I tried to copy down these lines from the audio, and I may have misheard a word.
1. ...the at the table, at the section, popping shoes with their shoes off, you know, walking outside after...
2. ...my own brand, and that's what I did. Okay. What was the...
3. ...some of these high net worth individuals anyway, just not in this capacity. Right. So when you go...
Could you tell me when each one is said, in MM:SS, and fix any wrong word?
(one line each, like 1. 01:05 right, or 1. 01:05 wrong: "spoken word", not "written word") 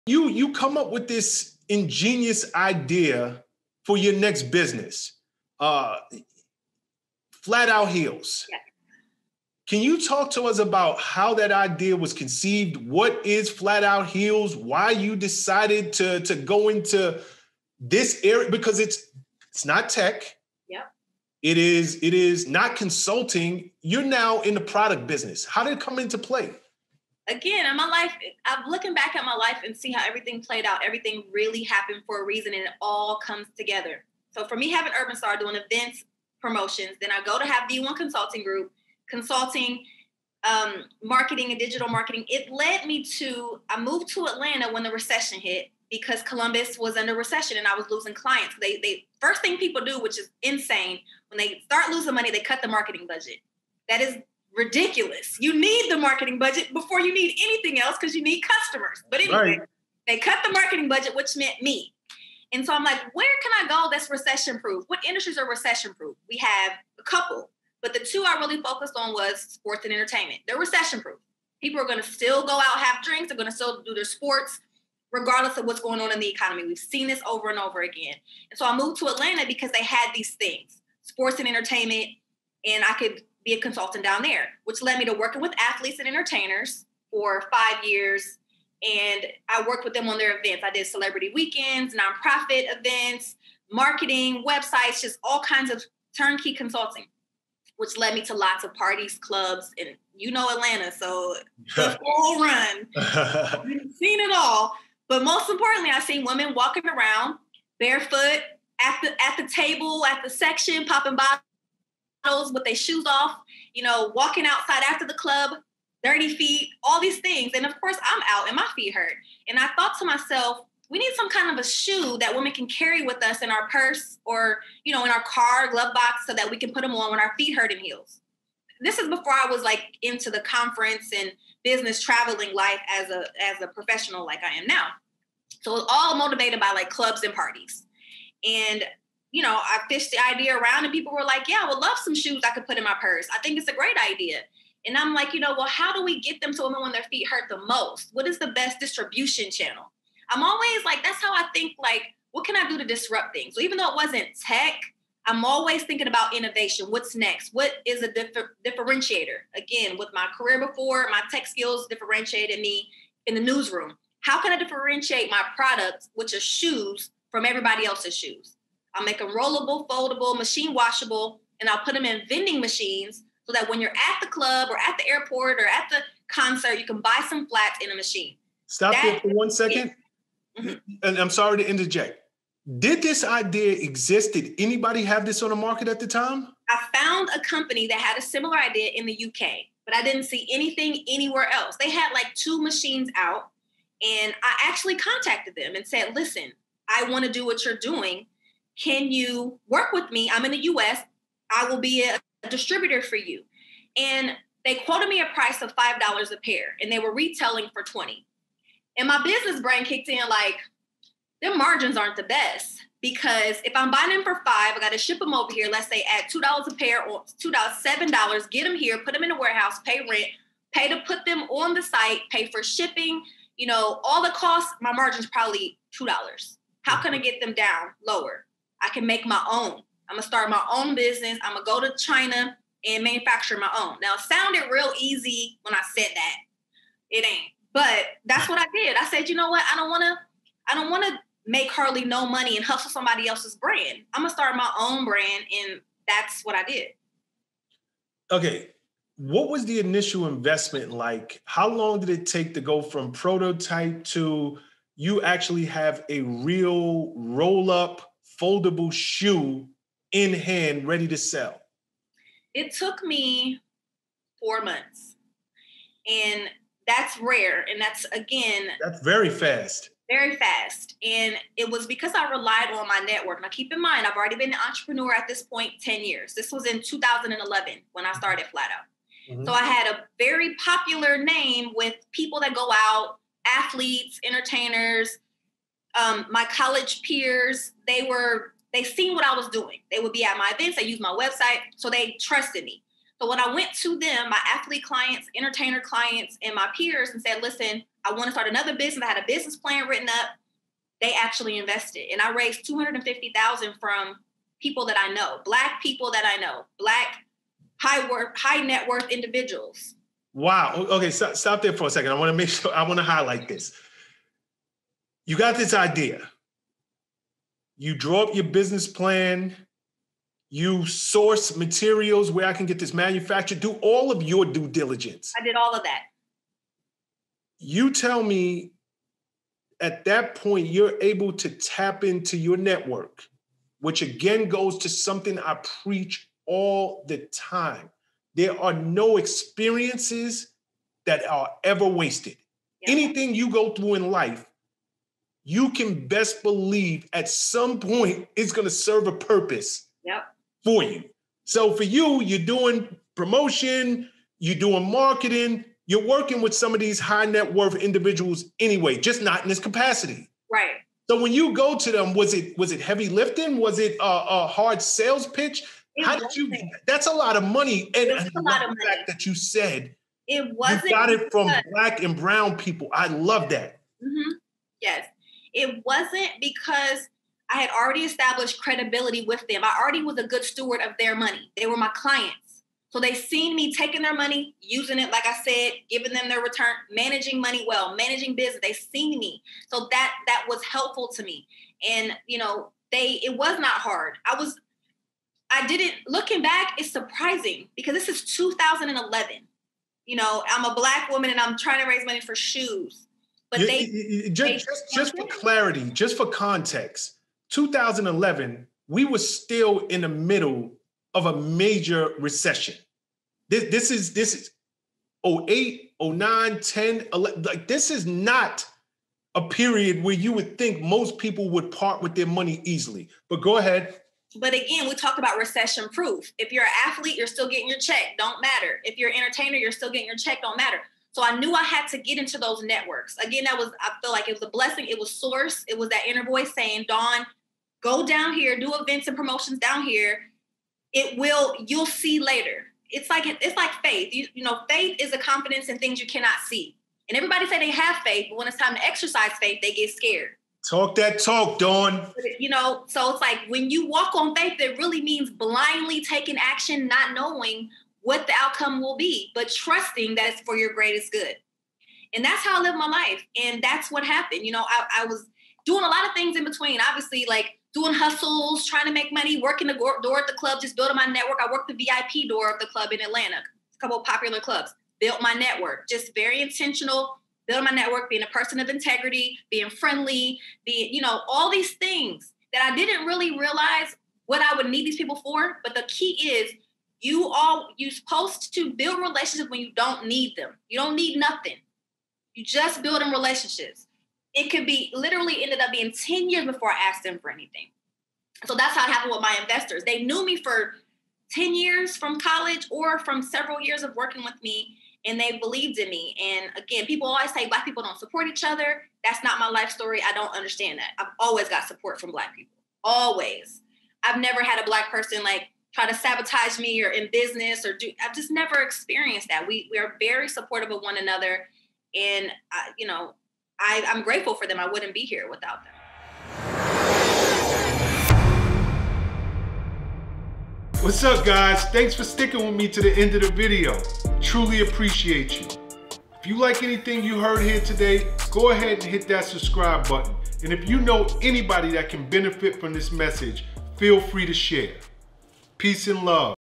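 1. 01:49 wrong: "bottles", not "shoes"
2. 04:04 right
3. 05:56 right.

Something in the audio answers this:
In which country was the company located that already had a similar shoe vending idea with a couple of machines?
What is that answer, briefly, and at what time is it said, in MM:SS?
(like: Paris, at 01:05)
UK, at 03:08.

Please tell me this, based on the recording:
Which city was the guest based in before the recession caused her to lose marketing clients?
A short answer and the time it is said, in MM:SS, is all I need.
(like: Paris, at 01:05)
Columbus, at 00:46.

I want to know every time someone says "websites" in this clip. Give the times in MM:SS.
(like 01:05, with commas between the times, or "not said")
01:34, 04:51.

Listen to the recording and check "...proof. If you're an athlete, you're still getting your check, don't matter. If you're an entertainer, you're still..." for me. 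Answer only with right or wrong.
right.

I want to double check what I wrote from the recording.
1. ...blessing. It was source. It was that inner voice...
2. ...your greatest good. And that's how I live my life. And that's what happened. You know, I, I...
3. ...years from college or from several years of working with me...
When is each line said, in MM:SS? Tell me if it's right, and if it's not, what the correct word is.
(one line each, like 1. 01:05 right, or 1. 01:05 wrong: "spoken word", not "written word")
1. 07:14 right
2. 07:40 right
3. 08:21 right.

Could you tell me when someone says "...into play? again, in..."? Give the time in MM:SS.
00:25.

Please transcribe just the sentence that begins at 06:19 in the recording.
I already was a good steward of their money.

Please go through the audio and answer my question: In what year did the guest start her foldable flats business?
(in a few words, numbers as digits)
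2011.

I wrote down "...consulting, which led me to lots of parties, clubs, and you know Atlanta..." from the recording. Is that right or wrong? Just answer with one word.
right.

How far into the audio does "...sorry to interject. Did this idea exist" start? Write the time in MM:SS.
03:01.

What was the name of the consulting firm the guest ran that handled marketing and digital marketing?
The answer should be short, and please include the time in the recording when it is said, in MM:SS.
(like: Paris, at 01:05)
V one Consulting Group, at 00:37.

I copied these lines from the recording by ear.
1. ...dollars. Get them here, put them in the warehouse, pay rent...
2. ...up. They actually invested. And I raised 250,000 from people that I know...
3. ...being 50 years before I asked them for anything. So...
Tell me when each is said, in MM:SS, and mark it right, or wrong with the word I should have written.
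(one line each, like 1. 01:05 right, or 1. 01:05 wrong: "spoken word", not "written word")
1. 03:38 right
2. 05:00 right
3. 08:15 wrong: "10", not "50".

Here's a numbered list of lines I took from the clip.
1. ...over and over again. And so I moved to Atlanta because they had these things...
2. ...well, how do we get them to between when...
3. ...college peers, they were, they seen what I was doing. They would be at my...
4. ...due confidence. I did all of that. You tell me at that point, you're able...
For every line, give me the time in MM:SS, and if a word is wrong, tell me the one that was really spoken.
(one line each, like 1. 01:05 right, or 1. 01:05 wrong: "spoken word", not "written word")
1. 01:17 right
2. 02:25 wrong: "women", not "between"
3. 04:46 right
4. 05:24 wrong: "diligence", not "confidence".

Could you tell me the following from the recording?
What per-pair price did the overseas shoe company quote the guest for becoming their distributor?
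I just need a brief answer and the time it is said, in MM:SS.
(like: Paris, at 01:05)
$5, at 03:25.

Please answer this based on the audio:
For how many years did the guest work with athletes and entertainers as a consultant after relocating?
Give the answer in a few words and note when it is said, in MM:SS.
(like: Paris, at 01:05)
5 years, at 01:27.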